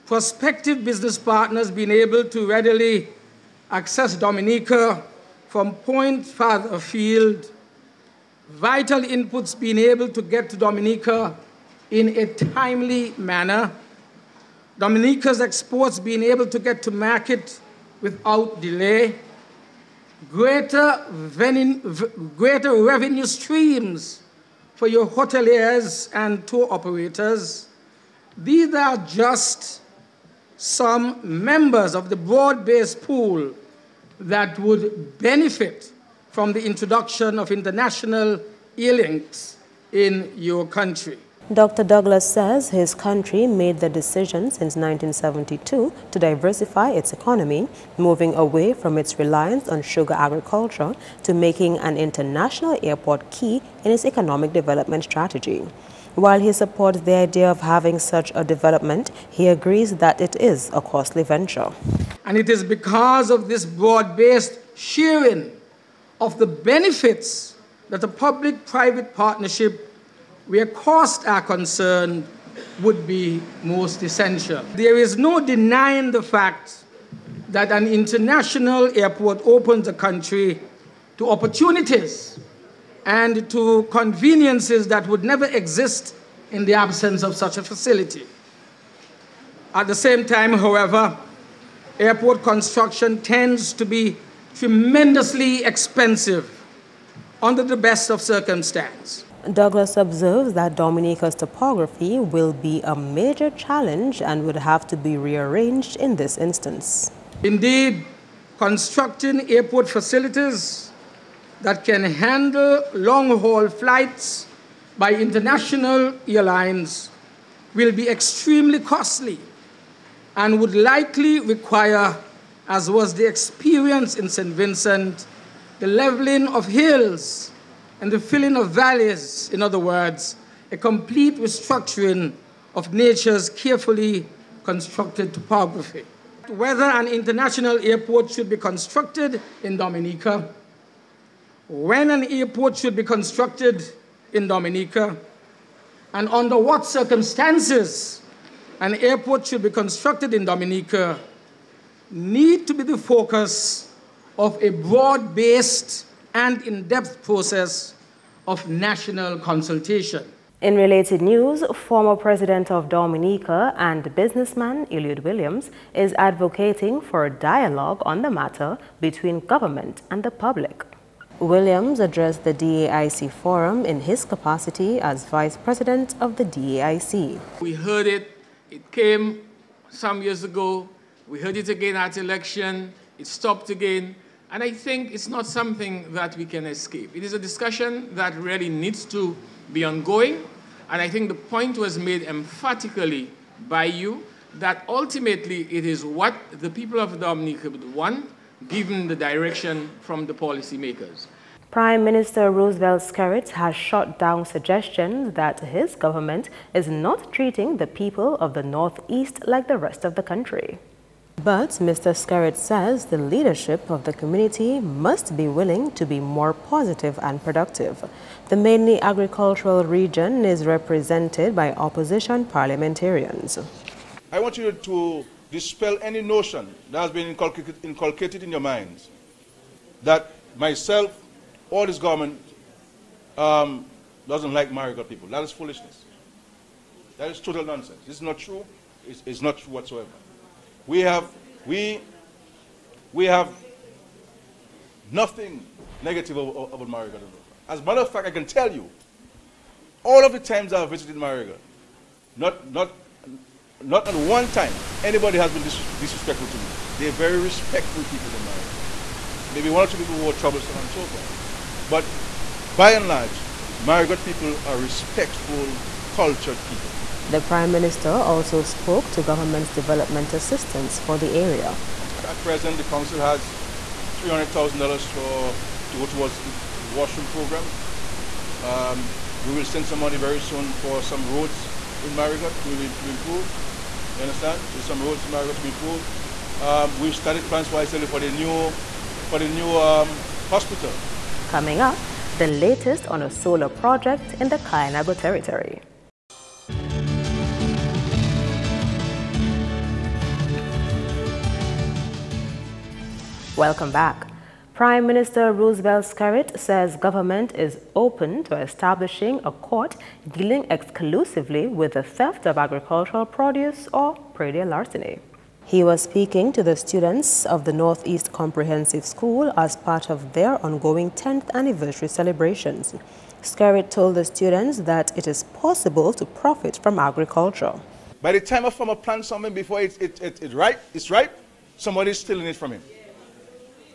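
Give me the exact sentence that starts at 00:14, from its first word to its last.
Dominica's exports being able to get to market without delay.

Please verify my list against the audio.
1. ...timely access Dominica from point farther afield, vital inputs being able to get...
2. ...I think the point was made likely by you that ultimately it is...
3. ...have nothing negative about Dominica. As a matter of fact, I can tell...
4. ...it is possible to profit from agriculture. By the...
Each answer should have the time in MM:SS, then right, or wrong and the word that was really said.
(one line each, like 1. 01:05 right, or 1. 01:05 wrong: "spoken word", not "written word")
1. 00:02 wrong: "readily", not "timely"
2. 03:11 wrong: "emphatically", not "likely"
3. 04:03 wrong: "Marigot", not "Dominica"
4. 05:25 right.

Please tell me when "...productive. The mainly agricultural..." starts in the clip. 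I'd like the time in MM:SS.
03:37.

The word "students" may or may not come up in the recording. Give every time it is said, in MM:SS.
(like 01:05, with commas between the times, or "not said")
05:16, 05:24.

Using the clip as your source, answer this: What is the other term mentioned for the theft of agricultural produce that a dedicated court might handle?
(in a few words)
predial larceny.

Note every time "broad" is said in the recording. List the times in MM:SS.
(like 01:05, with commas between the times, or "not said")
00:32, 01:03, 02:34.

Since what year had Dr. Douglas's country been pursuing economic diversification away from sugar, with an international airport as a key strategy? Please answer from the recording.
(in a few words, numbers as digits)
1972.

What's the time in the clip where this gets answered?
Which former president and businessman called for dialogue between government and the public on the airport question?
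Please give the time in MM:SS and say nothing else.
02:44.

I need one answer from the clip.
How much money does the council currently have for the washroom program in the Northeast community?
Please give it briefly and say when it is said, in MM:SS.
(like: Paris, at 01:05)
$300,000, at 04:34.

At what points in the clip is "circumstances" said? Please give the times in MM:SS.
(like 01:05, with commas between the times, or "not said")
01:38, 02:26.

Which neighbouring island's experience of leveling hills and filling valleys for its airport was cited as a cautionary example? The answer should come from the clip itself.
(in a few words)
St. Vincent.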